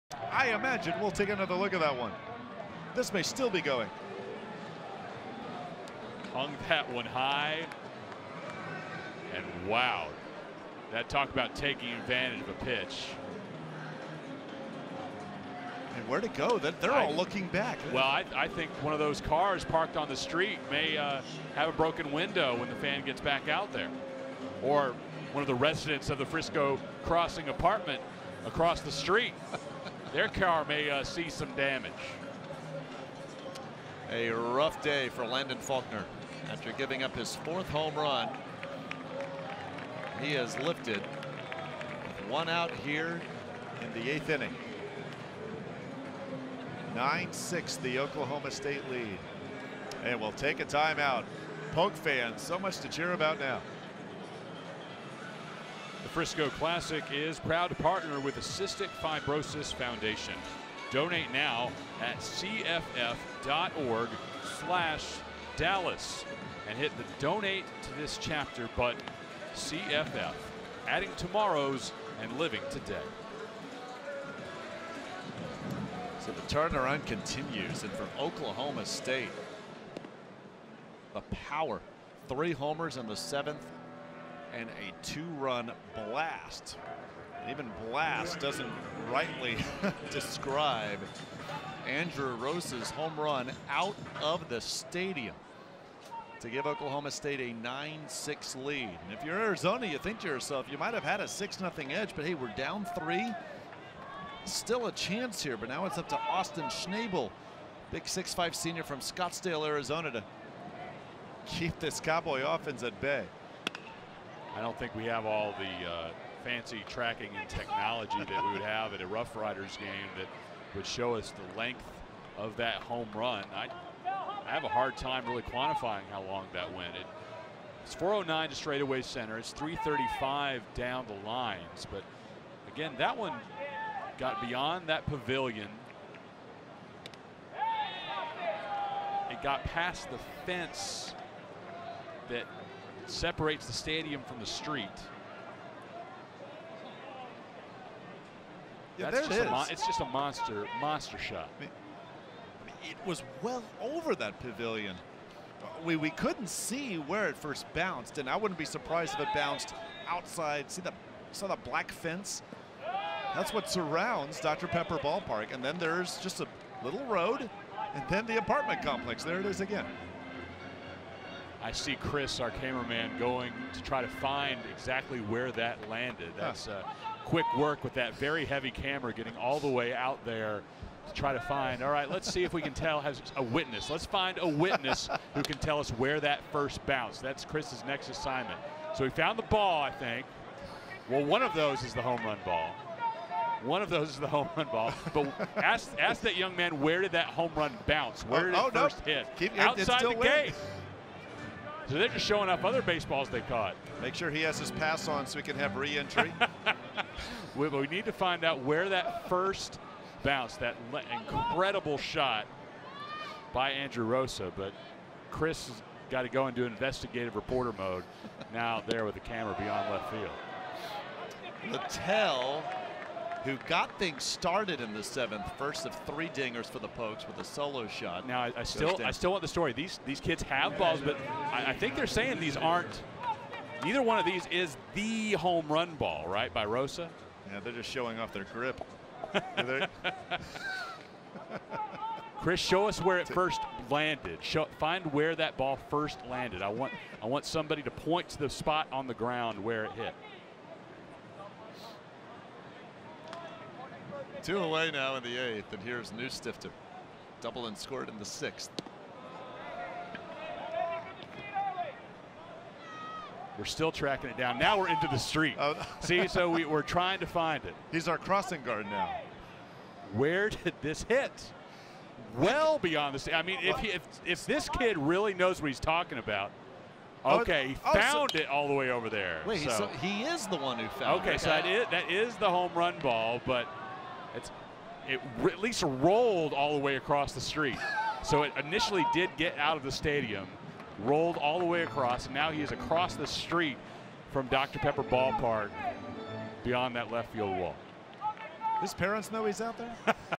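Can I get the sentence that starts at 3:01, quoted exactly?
All right, let's see if we can tell has a witness.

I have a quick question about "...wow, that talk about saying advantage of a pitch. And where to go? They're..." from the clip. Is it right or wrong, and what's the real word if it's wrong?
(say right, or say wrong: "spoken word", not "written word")
wrong: "taking", not "saying".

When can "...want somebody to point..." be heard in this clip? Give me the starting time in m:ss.
4:07.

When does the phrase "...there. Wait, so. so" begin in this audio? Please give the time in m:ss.
4:39.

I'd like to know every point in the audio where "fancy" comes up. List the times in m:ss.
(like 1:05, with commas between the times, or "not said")
1:56.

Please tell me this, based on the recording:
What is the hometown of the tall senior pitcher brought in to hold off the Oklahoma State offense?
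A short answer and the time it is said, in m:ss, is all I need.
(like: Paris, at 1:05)
Scottsdale, Arizona, at 1:48.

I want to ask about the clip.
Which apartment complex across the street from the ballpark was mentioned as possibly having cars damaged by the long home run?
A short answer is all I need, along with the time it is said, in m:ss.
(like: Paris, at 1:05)
Frisco Crossing, at 0:26.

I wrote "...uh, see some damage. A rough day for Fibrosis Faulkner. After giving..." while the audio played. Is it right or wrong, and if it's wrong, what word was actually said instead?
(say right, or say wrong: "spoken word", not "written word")
wrong: "Landon", not "Fibrosis".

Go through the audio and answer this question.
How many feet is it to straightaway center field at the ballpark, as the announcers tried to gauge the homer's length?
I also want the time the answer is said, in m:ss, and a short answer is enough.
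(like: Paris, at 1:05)
409, at 2:07.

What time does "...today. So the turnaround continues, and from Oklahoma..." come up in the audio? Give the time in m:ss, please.
1:12.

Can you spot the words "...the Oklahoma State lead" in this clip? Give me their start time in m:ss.
0:47.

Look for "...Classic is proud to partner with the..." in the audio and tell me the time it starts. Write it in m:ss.
0:56.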